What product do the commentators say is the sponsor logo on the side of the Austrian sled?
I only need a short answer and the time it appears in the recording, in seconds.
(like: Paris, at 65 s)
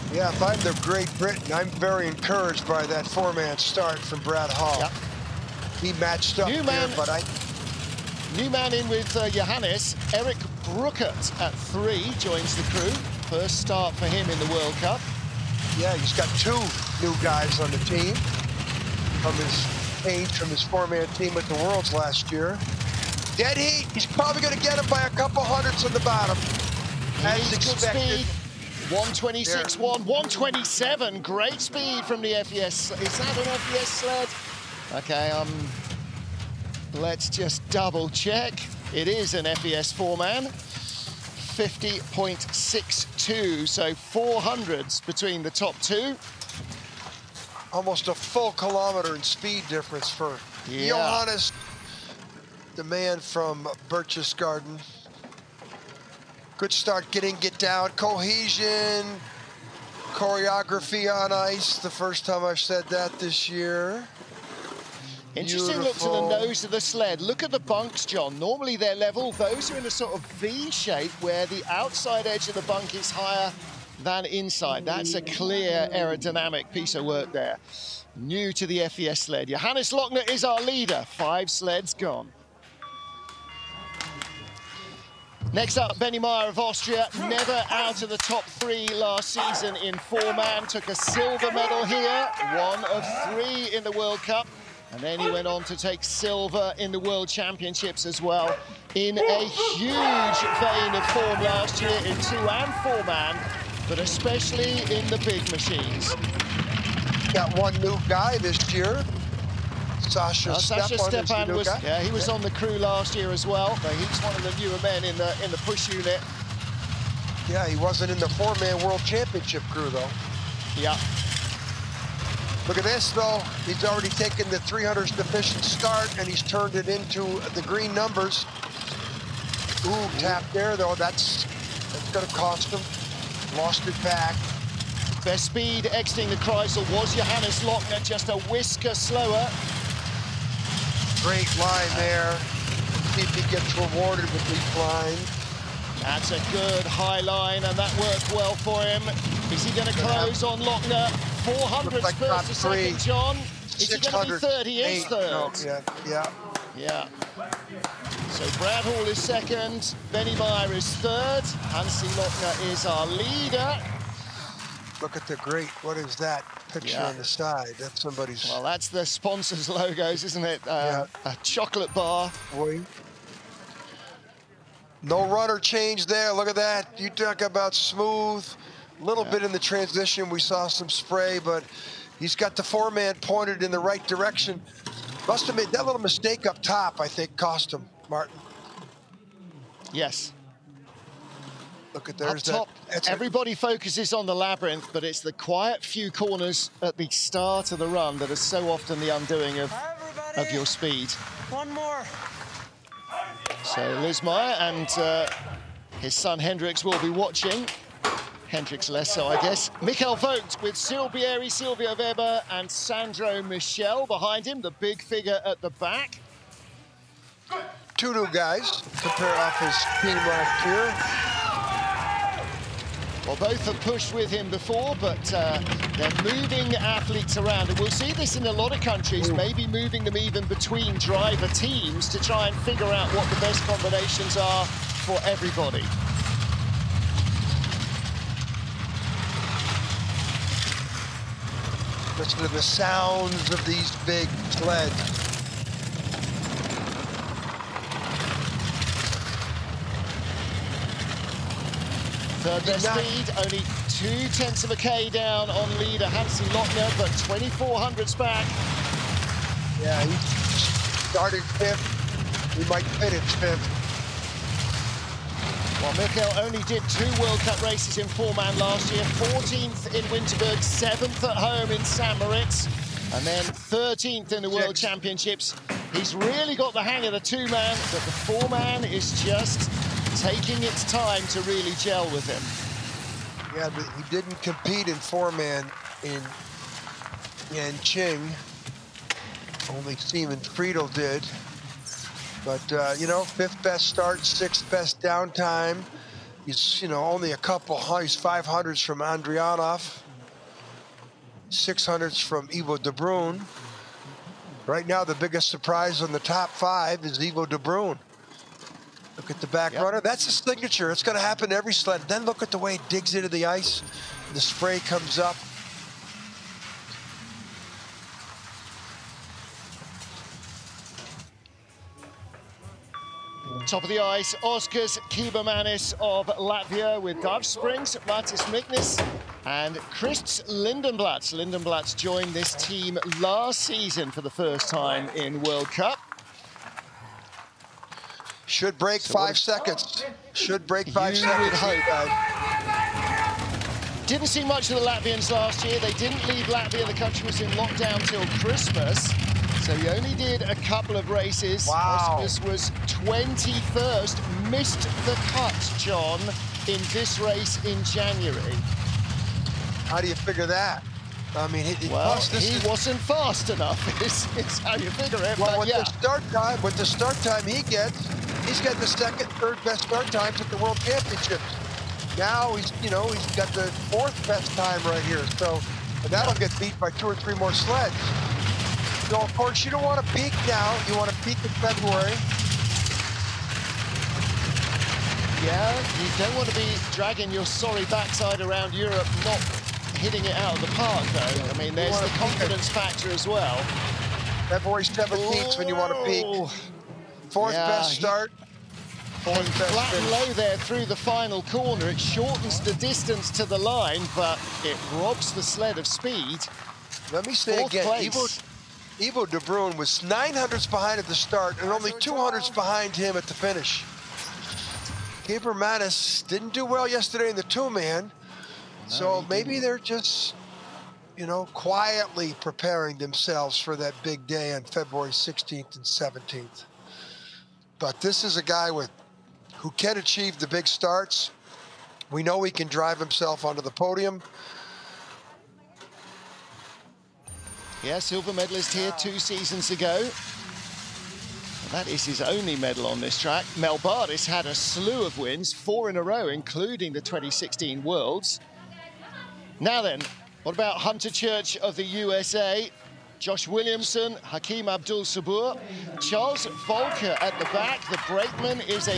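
A chocolate bar, at 171 s.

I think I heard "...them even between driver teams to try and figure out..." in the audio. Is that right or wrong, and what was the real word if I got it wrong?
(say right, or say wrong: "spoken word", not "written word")
right.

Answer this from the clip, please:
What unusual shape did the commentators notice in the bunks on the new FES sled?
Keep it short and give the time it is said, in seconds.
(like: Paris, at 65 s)
V shape, at 70 s.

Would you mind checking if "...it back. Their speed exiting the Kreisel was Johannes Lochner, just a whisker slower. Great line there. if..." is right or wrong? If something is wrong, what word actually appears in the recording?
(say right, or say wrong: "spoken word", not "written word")
right.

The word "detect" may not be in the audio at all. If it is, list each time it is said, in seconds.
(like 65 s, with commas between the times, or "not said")
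not said.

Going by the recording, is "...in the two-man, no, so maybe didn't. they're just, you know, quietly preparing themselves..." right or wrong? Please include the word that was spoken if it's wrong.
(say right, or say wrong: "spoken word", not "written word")
right.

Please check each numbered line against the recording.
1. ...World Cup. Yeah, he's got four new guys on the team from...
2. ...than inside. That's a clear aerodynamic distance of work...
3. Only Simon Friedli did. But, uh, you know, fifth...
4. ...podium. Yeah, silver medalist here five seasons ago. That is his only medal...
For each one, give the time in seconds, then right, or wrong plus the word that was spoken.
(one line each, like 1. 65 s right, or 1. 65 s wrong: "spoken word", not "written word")
1. 14 s wrong: "two", not "four"
2. 74 s wrong: "piece", not "distance"
3. 289 s right
4. 433 s wrong: "two", not "five".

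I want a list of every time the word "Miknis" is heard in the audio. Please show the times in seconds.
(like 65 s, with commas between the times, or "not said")
328 s.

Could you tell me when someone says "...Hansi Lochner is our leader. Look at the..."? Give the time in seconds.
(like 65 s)
161 s.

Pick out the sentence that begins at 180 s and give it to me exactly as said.
We saw some spray, but he's got the foreman pointed in the right direction.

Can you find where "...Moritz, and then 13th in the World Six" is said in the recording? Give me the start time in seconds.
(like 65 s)
272 s.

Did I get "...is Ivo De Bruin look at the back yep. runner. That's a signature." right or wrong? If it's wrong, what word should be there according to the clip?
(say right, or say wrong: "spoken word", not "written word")
right.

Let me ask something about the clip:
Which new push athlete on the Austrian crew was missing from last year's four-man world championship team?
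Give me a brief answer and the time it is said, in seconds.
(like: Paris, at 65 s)
Sasha Stepan, at 110 s.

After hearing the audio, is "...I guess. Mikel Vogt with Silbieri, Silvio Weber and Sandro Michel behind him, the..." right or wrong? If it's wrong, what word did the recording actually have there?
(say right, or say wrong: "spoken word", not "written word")
right.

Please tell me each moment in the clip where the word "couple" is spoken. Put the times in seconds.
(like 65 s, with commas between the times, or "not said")
25 s, 297 s, 350 s.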